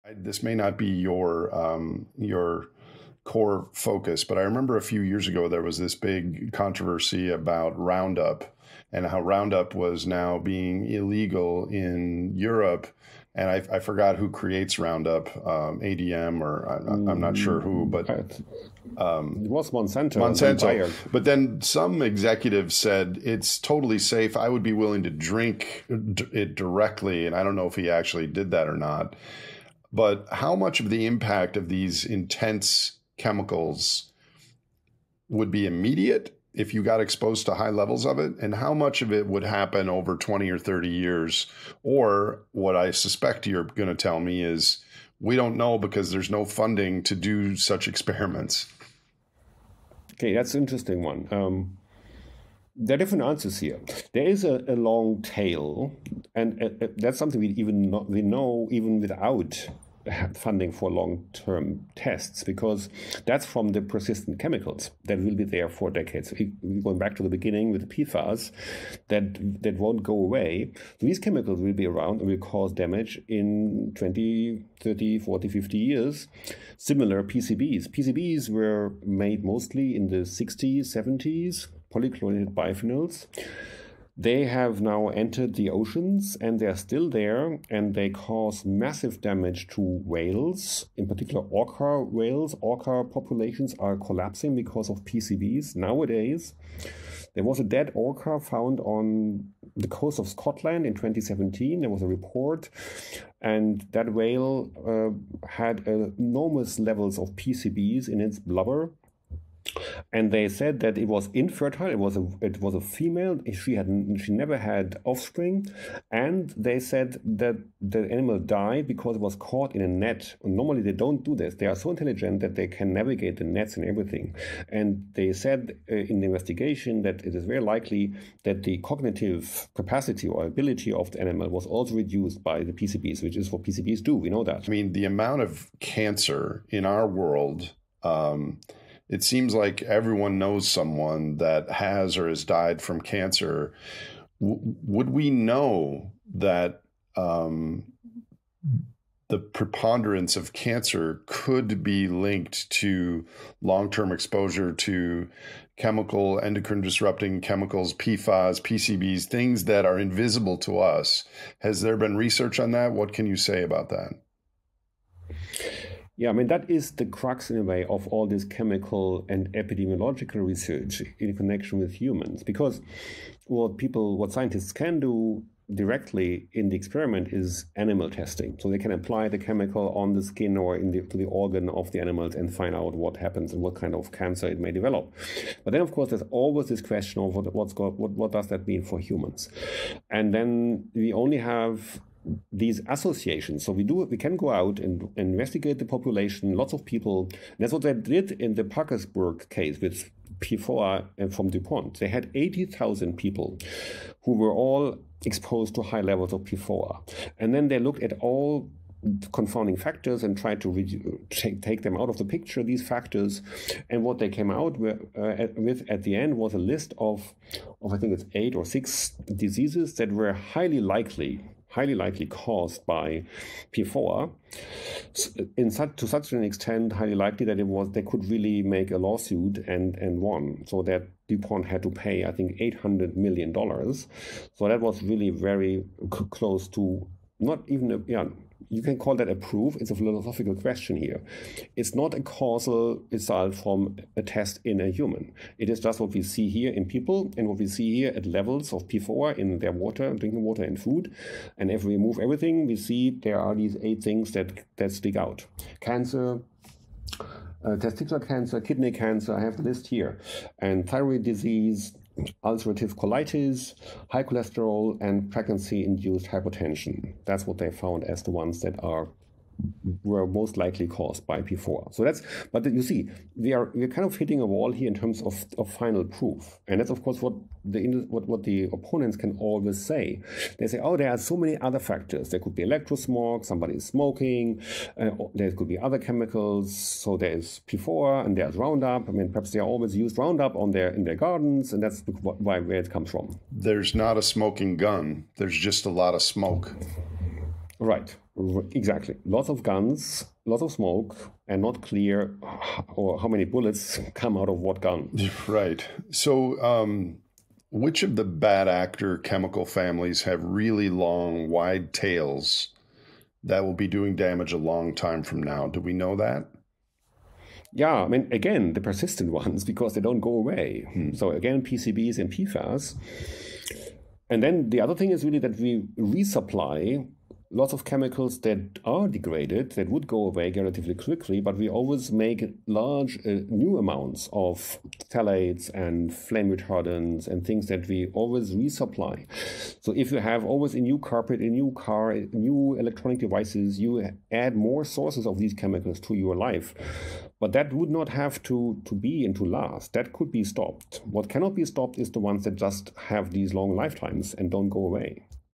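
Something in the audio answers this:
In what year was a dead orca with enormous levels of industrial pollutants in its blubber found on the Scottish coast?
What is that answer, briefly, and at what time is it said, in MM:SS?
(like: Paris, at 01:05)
2017, at 01:40.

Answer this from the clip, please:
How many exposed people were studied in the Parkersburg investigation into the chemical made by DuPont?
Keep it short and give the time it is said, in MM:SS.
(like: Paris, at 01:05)
80,000, at 03:22.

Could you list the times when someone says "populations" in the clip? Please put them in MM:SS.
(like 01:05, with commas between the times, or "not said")
01:33, 03:15.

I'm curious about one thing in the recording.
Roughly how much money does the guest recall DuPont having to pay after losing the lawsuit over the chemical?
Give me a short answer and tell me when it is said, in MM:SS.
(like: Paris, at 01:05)
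$800 million, at 03:52.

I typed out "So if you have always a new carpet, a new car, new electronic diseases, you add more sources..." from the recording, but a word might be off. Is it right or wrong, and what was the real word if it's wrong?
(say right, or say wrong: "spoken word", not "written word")
wrong: "devices", not "diseases".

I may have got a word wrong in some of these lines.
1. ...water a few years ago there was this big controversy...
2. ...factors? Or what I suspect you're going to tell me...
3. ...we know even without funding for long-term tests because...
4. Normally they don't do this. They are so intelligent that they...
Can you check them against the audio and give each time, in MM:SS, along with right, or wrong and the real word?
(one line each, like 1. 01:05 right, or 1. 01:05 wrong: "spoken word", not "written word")
1. 00:04 wrong: "remember", not "water"
2. 00:40 wrong: "years", not "factors"
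3. 00:58 right
4. 02:00 right.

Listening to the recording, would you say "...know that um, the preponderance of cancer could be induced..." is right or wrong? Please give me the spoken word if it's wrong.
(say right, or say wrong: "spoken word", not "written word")
wrong: "linked", not "induced".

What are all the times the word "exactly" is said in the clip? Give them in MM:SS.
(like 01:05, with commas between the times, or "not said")
04:58.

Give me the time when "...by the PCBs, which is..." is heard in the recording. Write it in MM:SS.
02:12.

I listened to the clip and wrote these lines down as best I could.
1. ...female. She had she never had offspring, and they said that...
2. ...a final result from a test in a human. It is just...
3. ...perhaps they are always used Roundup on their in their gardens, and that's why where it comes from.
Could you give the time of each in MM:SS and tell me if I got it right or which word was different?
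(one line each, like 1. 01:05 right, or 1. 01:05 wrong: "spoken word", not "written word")
1. 01:52 right
2. 04:02 wrong: "causal", not "final"
3. 04:49 right.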